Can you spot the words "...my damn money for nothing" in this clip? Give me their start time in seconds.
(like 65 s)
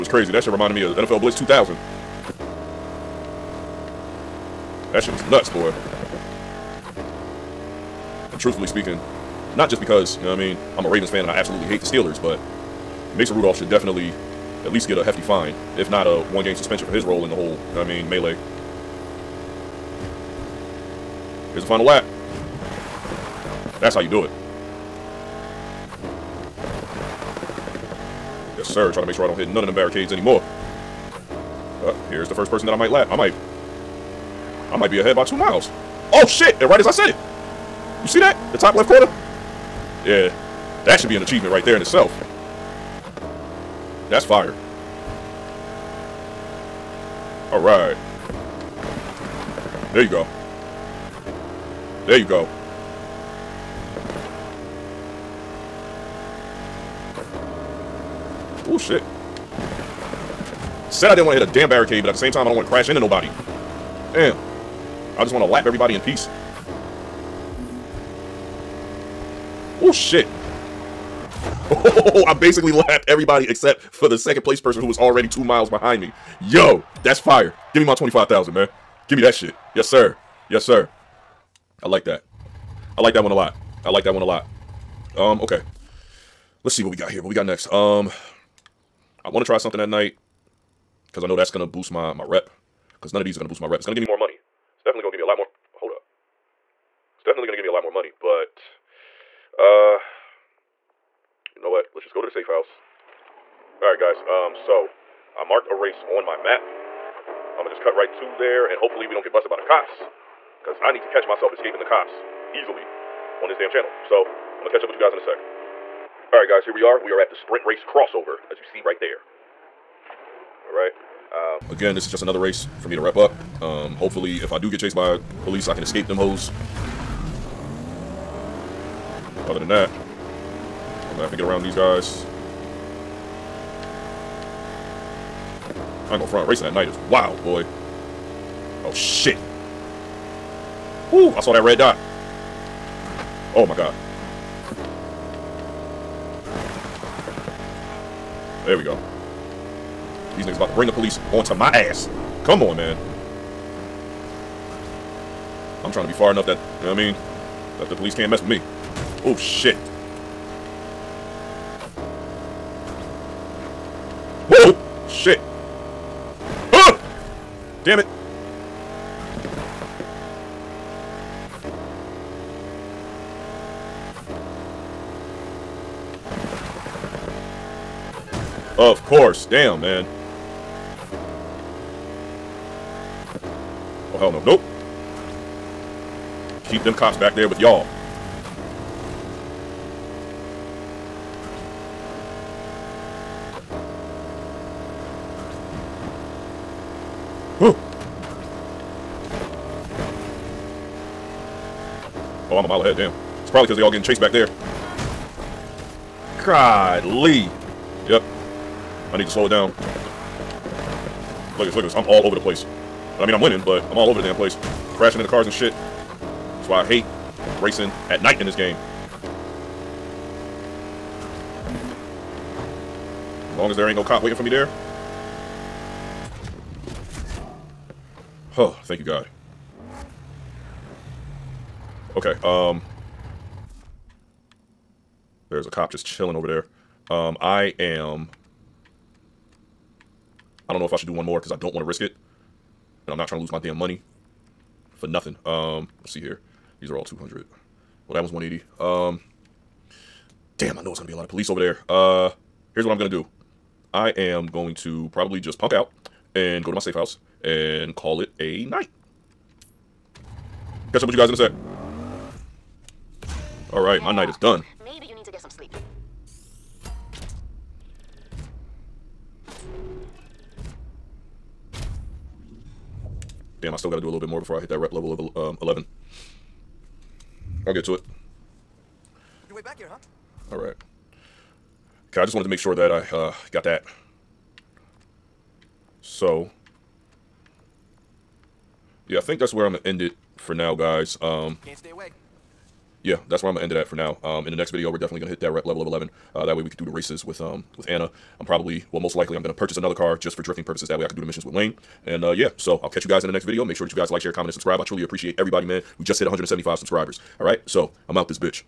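243 s.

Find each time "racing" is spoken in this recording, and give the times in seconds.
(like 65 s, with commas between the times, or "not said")
136 s, 217 s.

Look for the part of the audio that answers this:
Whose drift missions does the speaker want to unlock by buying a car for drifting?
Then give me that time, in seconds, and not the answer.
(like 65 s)
301 s.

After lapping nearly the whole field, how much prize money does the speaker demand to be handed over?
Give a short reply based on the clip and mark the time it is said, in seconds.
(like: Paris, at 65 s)
25,000, at 77 s.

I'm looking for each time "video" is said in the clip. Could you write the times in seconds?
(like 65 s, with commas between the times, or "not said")
294 s, 303 s.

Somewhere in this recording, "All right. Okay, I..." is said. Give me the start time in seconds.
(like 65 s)
280 s.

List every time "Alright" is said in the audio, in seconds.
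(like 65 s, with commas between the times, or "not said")
103 s, 116 s, 120 s, 263 s.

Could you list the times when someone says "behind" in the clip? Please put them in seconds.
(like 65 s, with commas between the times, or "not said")
75 s.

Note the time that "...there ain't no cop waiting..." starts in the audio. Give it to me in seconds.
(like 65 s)
223 s.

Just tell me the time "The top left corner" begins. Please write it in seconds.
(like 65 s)
38 s.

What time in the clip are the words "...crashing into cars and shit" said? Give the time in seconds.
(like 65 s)
214 s.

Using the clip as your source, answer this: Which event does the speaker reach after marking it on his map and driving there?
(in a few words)
Sprint race crossover.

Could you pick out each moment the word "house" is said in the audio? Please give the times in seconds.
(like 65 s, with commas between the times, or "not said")
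102 s, 256 s.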